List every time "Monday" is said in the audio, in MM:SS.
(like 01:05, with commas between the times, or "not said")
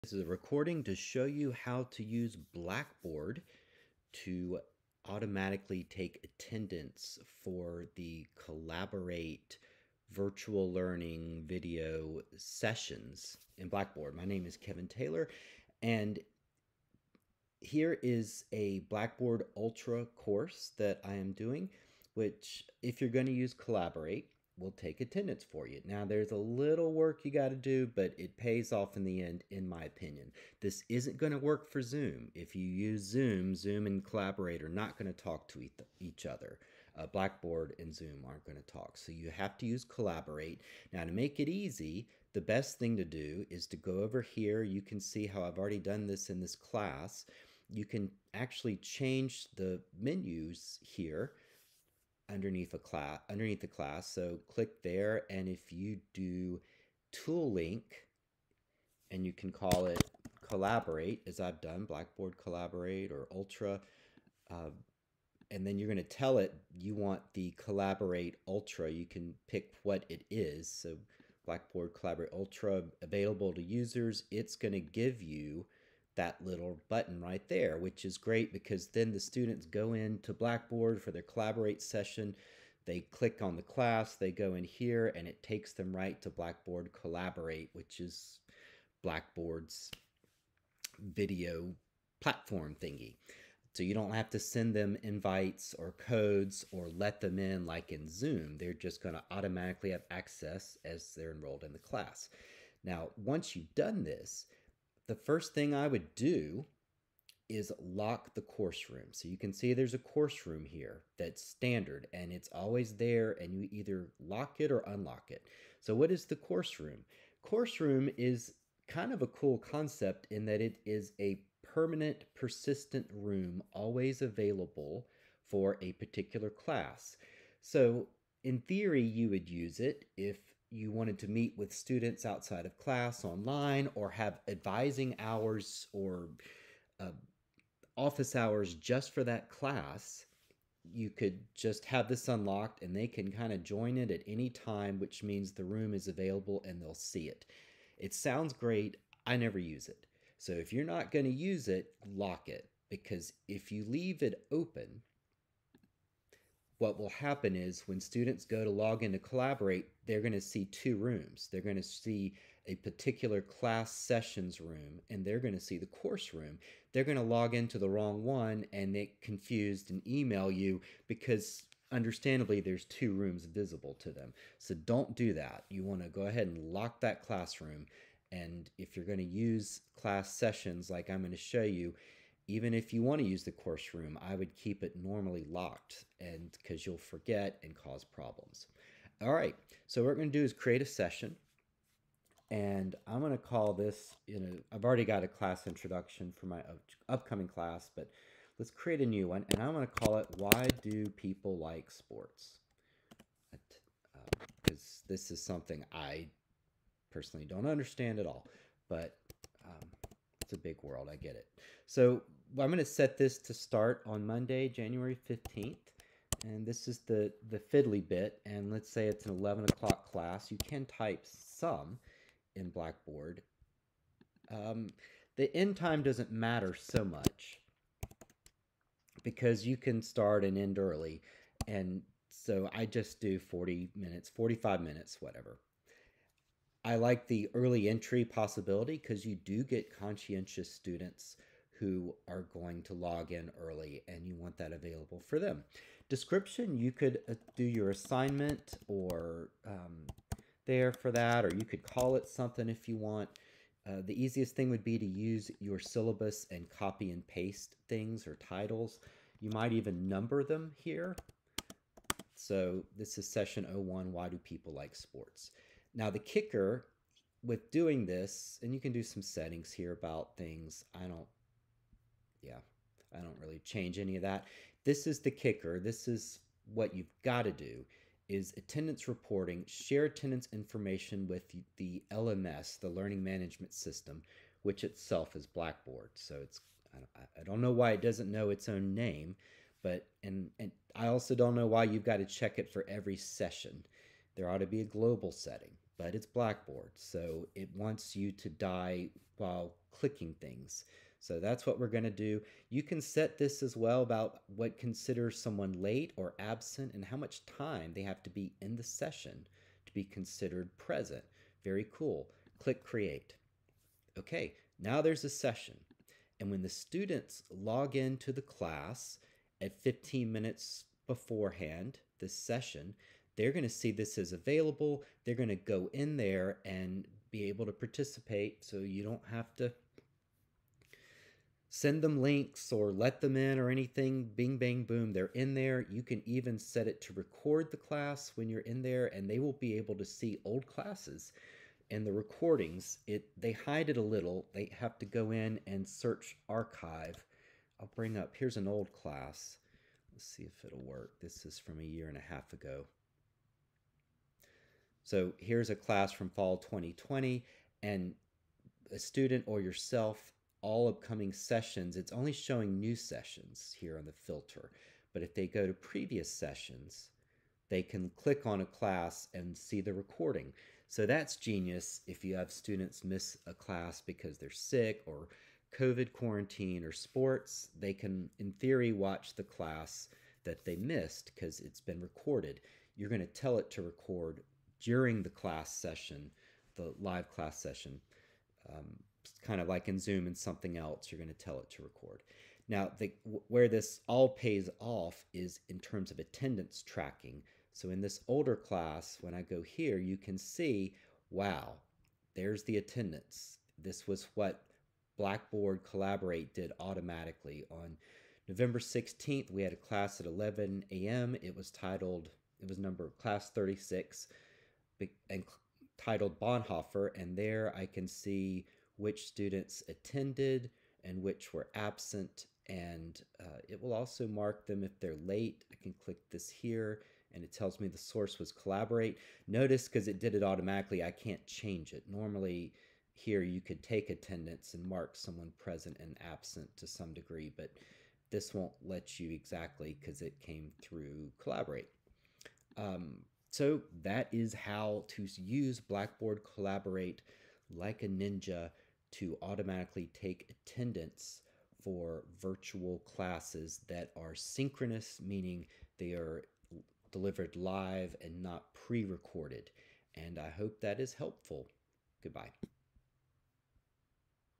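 03:34.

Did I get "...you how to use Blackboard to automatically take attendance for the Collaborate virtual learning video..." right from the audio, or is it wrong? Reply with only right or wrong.
right.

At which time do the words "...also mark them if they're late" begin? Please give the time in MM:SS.
07:03.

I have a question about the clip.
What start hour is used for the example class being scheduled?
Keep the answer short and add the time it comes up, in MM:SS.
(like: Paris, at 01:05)
11 o'clock, at 03:39.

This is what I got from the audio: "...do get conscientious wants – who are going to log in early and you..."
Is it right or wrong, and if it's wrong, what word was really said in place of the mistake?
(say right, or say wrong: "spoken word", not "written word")
wrong: "students", not "wants".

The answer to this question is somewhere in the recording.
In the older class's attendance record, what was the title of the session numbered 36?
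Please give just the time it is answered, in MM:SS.
06:56.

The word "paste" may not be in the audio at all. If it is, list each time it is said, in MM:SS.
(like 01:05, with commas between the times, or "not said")
04:17.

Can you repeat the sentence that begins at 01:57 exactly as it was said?
Course room is kind of a cool concept in that it is a permanent persistent room always available for a particular class.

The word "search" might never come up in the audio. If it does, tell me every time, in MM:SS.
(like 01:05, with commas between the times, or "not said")
05:45.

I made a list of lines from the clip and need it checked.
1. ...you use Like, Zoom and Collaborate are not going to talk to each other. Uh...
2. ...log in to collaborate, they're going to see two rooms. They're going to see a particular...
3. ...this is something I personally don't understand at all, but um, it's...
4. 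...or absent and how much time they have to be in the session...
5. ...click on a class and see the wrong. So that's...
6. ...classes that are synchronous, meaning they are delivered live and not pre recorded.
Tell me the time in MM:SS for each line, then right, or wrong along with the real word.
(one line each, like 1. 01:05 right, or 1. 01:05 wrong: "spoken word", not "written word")
1. 00:32 wrong: "Zoom", not "Like"
2. 02:38 right
3. 03:25 right
4. 05:06 right
5. 06:08 wrong: "recording", not "wrong"
6. 07:32 right.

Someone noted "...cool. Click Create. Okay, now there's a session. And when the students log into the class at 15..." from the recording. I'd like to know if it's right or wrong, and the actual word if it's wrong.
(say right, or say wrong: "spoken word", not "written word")
right.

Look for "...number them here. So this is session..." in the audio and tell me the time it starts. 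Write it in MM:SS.
04:20.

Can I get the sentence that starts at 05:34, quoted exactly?
Bing, bang, boom, they're in there.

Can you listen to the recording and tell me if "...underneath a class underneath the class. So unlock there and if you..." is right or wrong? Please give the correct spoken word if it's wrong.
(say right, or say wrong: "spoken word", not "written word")
wrong: "click", not "unlock".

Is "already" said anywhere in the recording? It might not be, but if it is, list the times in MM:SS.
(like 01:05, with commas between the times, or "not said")
00:45, 03:14.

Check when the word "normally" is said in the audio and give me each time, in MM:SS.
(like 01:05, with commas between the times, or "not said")
03:05, 07:12.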